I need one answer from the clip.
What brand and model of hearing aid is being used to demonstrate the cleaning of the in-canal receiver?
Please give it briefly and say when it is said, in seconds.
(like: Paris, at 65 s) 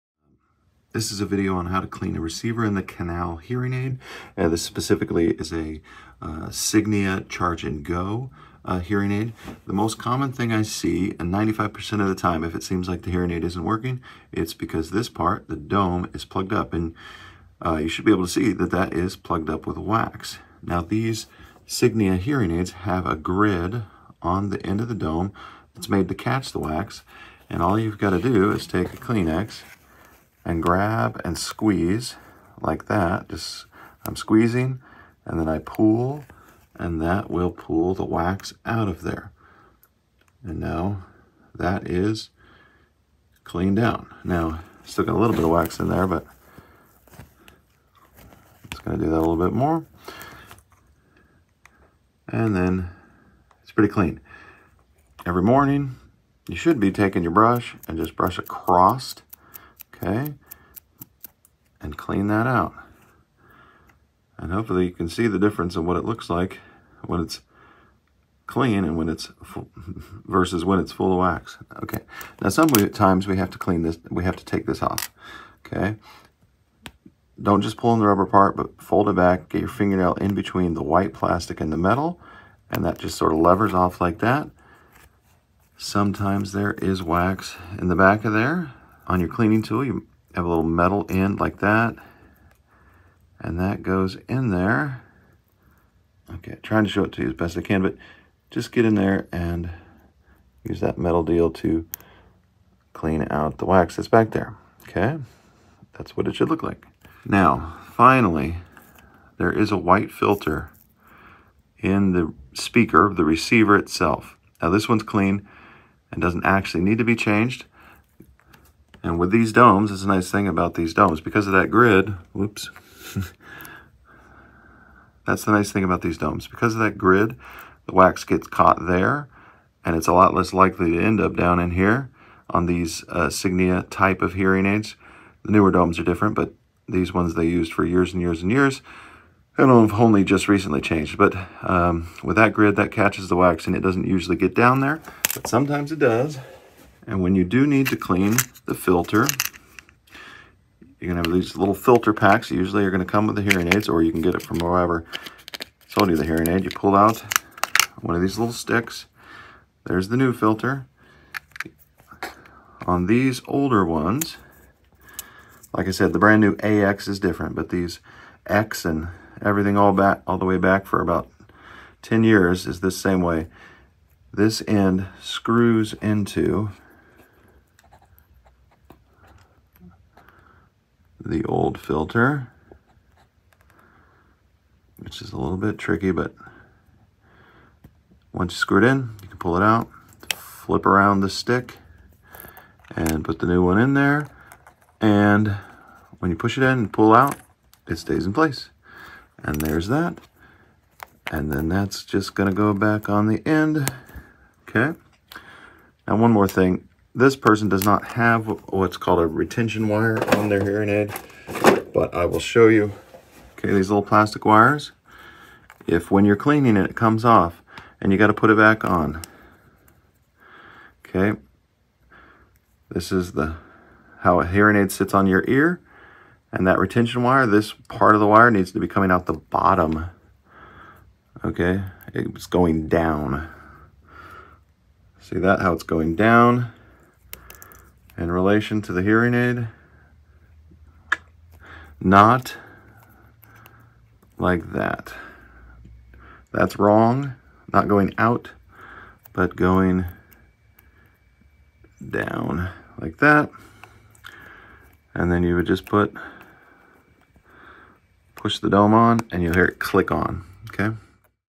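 Signia Charge and Go, at 6 s.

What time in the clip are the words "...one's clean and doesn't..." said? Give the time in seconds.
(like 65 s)
114 s.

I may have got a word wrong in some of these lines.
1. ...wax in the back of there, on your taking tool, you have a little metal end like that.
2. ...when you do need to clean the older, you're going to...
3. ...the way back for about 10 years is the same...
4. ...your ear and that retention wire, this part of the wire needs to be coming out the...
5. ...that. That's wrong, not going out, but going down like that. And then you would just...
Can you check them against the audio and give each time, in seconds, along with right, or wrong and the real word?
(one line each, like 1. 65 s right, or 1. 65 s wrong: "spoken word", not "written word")
1. 87 s wrong: "cleaning", not "taking"
2. 147 s wrong: "filter", not "older"
3. 170 s right
4. 225 s right
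5. 244 s right.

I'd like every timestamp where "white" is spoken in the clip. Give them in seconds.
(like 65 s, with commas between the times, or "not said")
80 s, 109 s.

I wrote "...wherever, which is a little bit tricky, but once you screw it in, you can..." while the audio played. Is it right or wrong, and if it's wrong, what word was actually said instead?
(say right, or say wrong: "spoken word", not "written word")
wrong: "filter", not "wherever".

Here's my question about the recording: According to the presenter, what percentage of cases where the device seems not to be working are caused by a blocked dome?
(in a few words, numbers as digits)
95%.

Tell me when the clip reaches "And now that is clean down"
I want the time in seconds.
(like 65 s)
40 s.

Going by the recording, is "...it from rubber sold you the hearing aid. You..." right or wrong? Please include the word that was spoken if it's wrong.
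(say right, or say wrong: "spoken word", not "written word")
wrong: "wherever", not "rubber".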